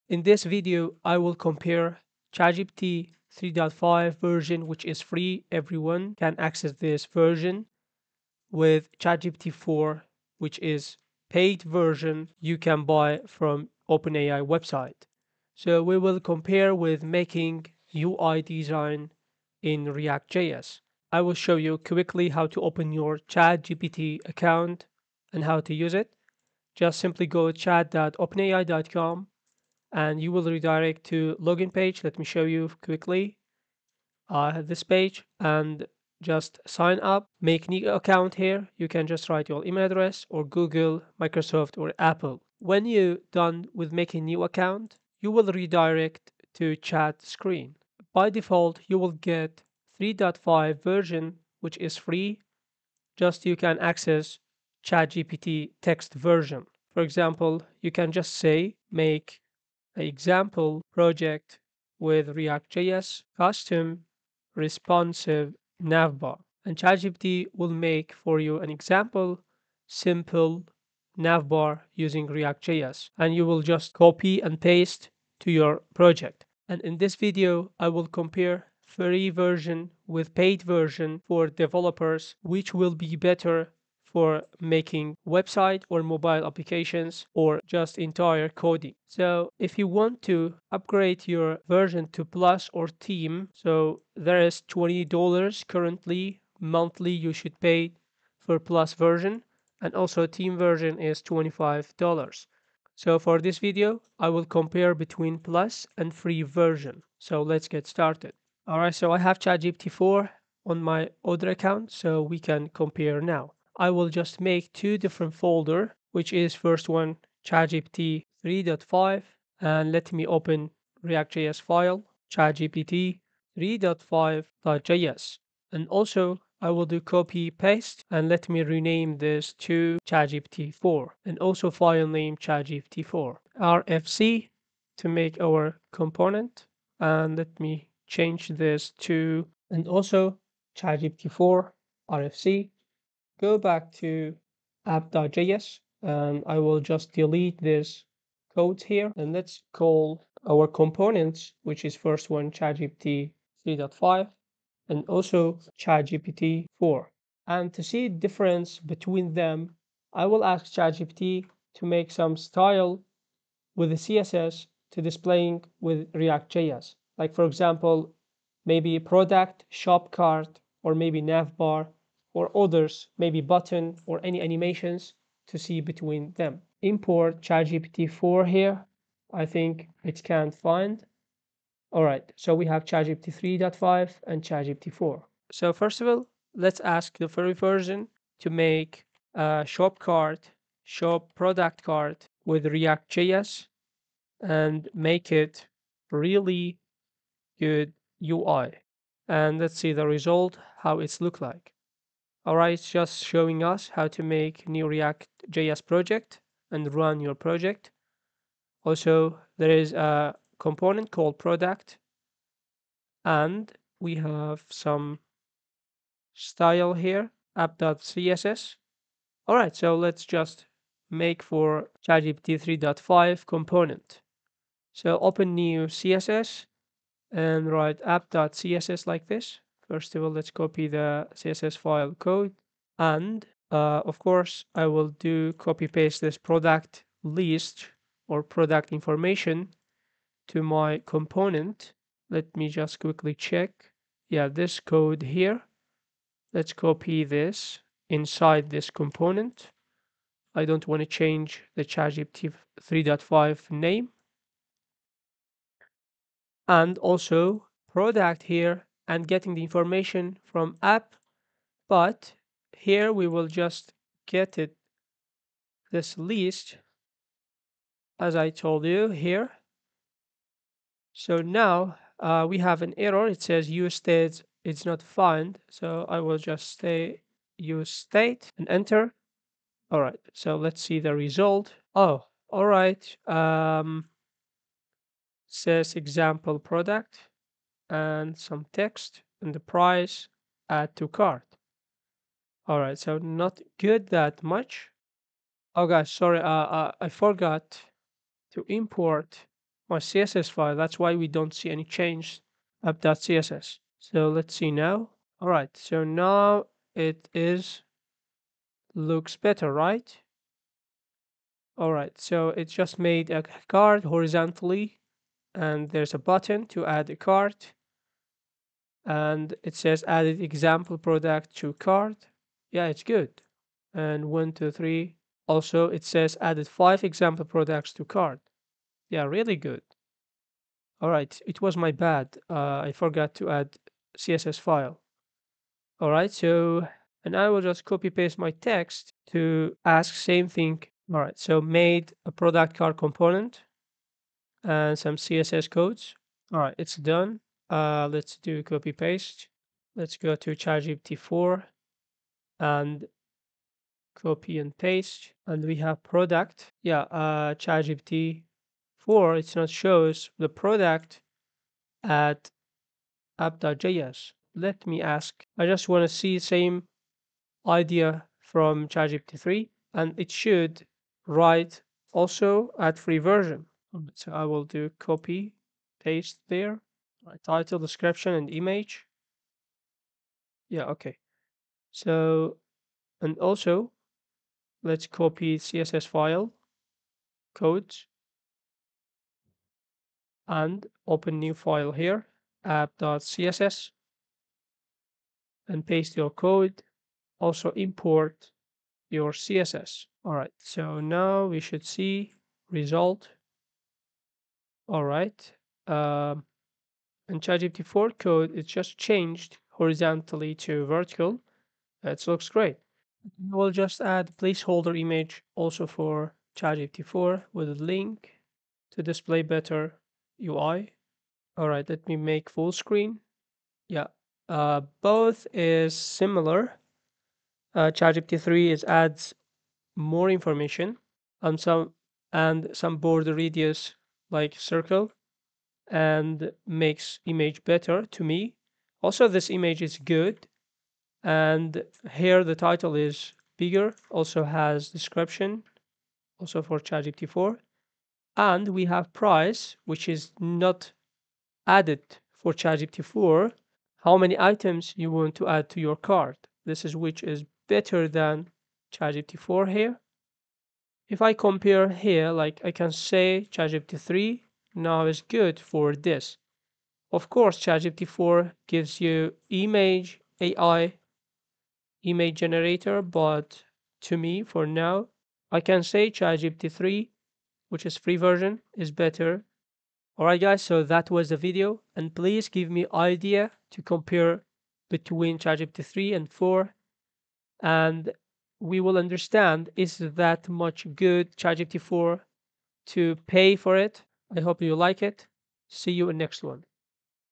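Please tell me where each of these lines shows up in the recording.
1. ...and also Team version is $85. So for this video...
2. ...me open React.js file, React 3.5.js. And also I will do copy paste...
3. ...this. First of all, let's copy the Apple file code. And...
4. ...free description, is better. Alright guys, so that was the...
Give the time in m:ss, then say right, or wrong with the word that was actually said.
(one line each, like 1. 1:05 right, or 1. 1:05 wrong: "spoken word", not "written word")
1. 1:39 wrong: "25", not "85"
2. 2:00 wrong: "ChatGPT", not "React"
3. 3:49 wrong: "CSS", not "Apple"
4. 7:57 wrong: "version", not "description".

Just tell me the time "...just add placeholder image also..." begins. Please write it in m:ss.
6:53.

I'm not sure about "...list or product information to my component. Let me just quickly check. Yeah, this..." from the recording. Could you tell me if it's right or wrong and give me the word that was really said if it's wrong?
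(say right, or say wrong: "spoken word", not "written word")
right.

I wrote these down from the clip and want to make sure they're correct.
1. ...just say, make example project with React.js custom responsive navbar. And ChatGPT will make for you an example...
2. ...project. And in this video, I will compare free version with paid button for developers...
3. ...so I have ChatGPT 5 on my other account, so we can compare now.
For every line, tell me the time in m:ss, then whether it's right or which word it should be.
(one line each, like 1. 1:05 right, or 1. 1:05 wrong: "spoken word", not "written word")
1. 0:58 right
2. 1:15 wrong: "version", not "button"
3. 1:48 wrong: "4", not "5".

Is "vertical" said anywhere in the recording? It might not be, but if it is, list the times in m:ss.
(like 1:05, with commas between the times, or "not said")
6:50.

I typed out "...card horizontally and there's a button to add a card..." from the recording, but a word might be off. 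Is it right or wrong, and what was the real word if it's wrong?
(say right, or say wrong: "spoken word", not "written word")
right.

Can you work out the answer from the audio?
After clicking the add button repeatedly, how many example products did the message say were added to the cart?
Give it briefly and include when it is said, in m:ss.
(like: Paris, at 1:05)
5, at 5:26.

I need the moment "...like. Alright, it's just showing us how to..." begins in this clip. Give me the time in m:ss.
3:21.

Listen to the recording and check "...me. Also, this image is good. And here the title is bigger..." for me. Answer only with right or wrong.
right.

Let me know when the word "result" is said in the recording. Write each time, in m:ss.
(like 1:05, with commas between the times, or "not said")
3:20, 4:41, 6:42.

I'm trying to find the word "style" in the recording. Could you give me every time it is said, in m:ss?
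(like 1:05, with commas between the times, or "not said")
2:42, 3:36.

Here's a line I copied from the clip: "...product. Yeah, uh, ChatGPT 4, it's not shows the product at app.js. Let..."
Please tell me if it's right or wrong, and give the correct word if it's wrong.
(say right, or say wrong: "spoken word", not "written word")
right.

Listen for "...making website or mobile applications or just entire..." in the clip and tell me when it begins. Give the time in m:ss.
1:24.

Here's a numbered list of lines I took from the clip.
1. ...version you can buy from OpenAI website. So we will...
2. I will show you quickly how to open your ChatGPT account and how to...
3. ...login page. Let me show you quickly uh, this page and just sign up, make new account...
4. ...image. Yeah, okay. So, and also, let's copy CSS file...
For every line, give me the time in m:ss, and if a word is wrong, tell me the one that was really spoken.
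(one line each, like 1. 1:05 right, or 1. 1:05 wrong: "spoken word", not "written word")
1. 0:11 right
2. 0:21 right
3. 0:31 right
4. 6:18 right.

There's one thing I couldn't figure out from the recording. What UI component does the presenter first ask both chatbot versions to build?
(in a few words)
shop product cart.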